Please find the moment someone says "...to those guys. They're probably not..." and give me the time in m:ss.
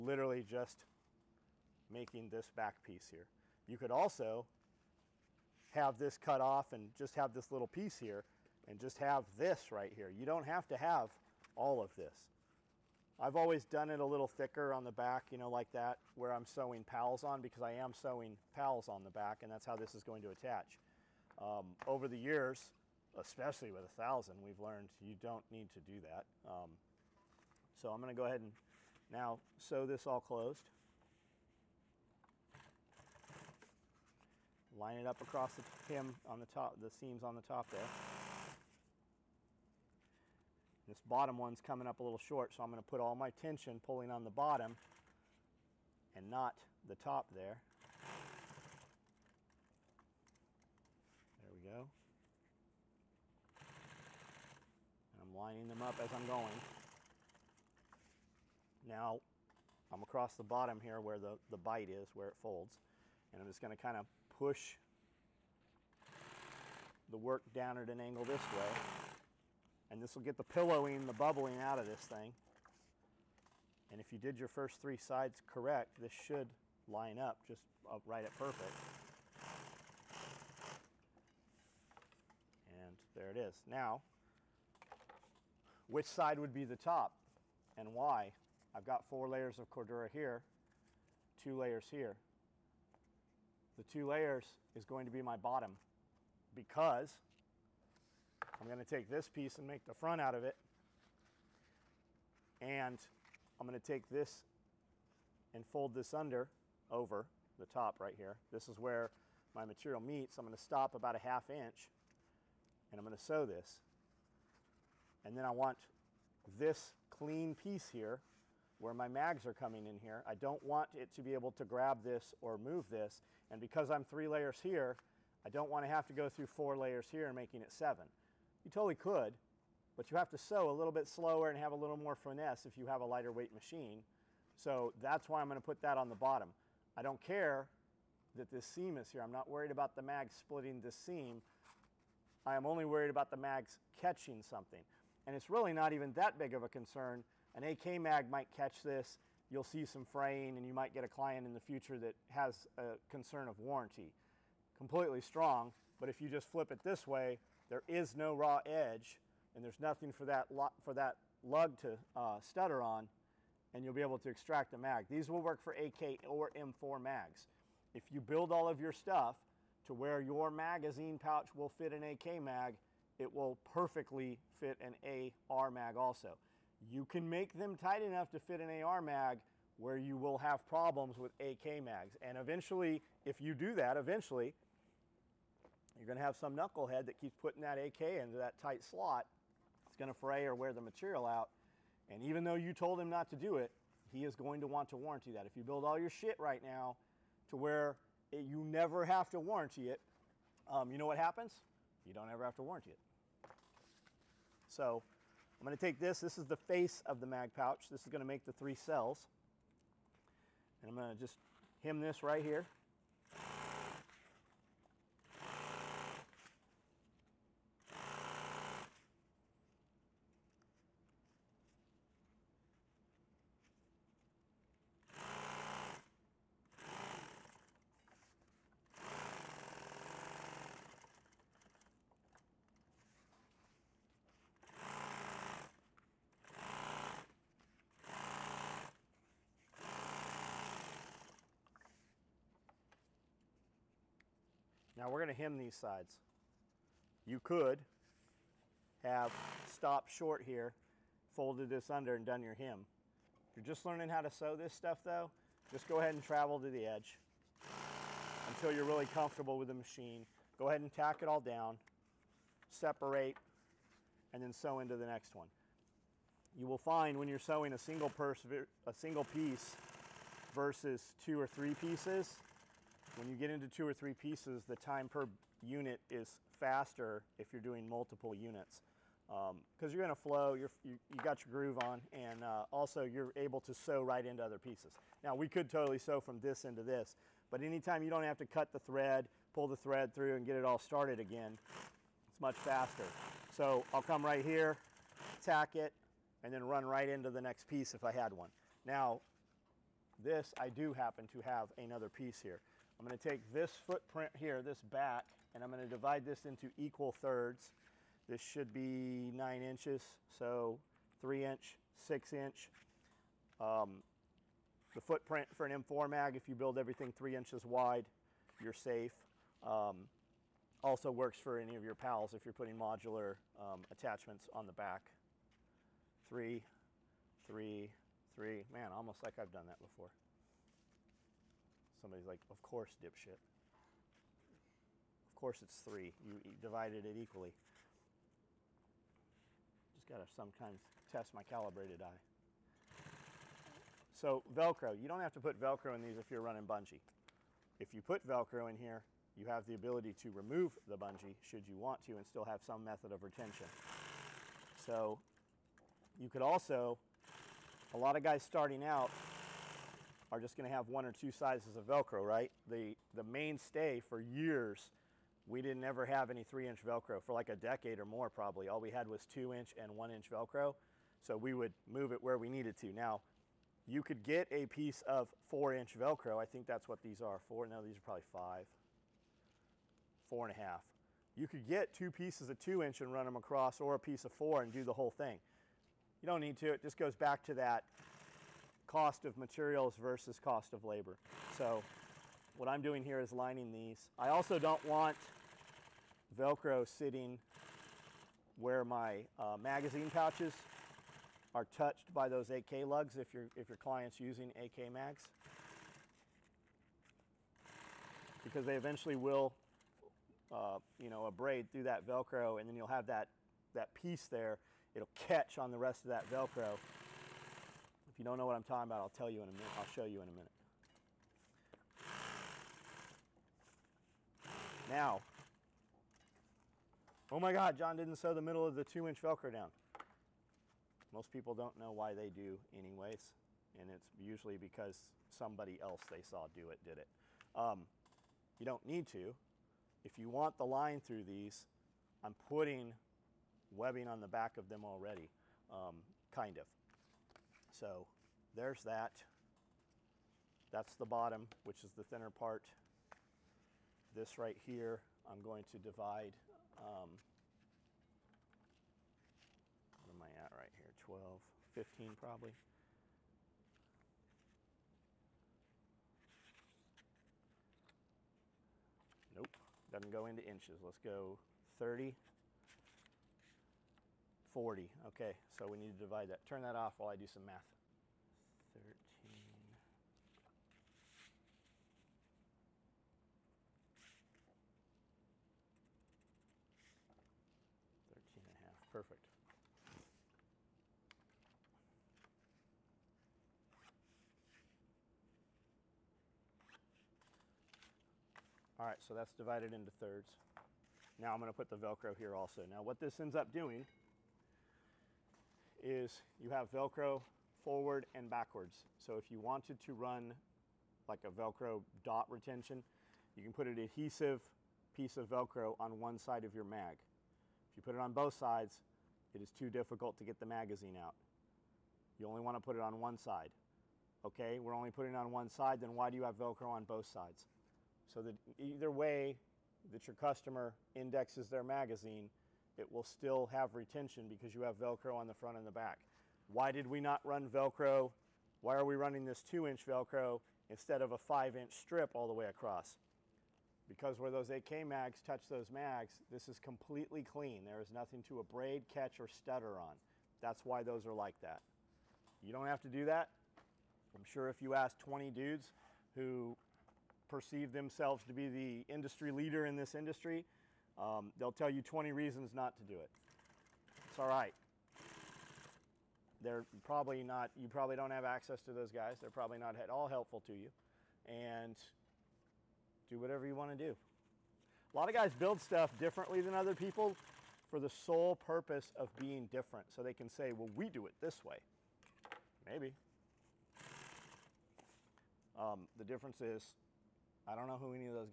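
9:28.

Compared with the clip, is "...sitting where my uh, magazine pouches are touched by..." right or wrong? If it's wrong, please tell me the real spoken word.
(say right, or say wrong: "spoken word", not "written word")
right.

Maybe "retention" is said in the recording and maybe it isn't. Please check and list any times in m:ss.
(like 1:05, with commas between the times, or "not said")
5:53, 8:32, 8:53.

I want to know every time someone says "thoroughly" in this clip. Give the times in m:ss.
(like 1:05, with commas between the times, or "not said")
not said.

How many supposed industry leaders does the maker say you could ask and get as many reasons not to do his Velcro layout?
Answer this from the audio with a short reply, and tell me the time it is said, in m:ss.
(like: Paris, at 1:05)
20, at 9:14.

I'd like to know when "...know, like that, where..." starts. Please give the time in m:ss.
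0:15.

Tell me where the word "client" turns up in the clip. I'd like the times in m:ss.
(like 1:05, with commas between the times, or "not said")
2:31, 6:43.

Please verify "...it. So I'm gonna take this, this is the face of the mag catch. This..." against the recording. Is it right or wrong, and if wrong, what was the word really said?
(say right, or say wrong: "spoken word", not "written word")
wrong: "pouch", not "catch".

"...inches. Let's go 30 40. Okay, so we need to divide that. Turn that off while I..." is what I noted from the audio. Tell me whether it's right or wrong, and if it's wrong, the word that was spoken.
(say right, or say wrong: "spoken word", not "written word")
right.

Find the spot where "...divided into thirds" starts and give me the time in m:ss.
8:19.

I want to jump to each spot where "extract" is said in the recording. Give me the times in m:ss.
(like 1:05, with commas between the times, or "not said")
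2:44.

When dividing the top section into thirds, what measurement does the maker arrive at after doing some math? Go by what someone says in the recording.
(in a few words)
13 and a half.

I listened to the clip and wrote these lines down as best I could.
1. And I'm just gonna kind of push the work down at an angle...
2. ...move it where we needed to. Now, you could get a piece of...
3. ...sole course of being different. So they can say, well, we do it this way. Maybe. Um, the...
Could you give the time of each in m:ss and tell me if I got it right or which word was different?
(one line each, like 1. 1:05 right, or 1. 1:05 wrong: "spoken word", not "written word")
1. 1:03 right
2. 6:11 right
3. 9:37 wrong: "purpose", not "course".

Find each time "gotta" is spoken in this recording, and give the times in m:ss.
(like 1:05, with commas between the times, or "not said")
5:40.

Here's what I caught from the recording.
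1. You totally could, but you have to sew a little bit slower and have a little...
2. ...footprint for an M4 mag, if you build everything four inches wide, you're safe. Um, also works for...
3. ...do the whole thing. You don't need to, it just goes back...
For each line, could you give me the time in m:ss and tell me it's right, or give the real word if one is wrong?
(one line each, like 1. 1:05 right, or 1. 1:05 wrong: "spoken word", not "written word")
1. 2:08 right
2. 5:14 wrong: "three", not "four"
3. 6:24 right.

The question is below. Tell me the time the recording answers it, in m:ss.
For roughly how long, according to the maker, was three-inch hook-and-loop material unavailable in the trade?
6:07.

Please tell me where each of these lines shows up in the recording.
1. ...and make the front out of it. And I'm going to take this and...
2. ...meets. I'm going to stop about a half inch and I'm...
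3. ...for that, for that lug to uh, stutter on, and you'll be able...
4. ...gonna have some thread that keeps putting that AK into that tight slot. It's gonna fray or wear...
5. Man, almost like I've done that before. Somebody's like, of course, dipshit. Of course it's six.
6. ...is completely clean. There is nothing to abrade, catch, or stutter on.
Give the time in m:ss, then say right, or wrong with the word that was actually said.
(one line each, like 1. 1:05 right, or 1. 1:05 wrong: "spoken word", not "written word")
1. 1:39 right
2. 1:49 right
3. 2:40 right
4. 3:06 wrong: "knucklehead", not "thread"
5. 5:28 wrong: "three", not "six"
6. 9:06 right.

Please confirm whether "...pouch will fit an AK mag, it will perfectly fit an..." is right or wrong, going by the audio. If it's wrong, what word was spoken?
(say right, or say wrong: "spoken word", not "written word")
right.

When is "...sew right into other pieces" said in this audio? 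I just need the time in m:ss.
4:43.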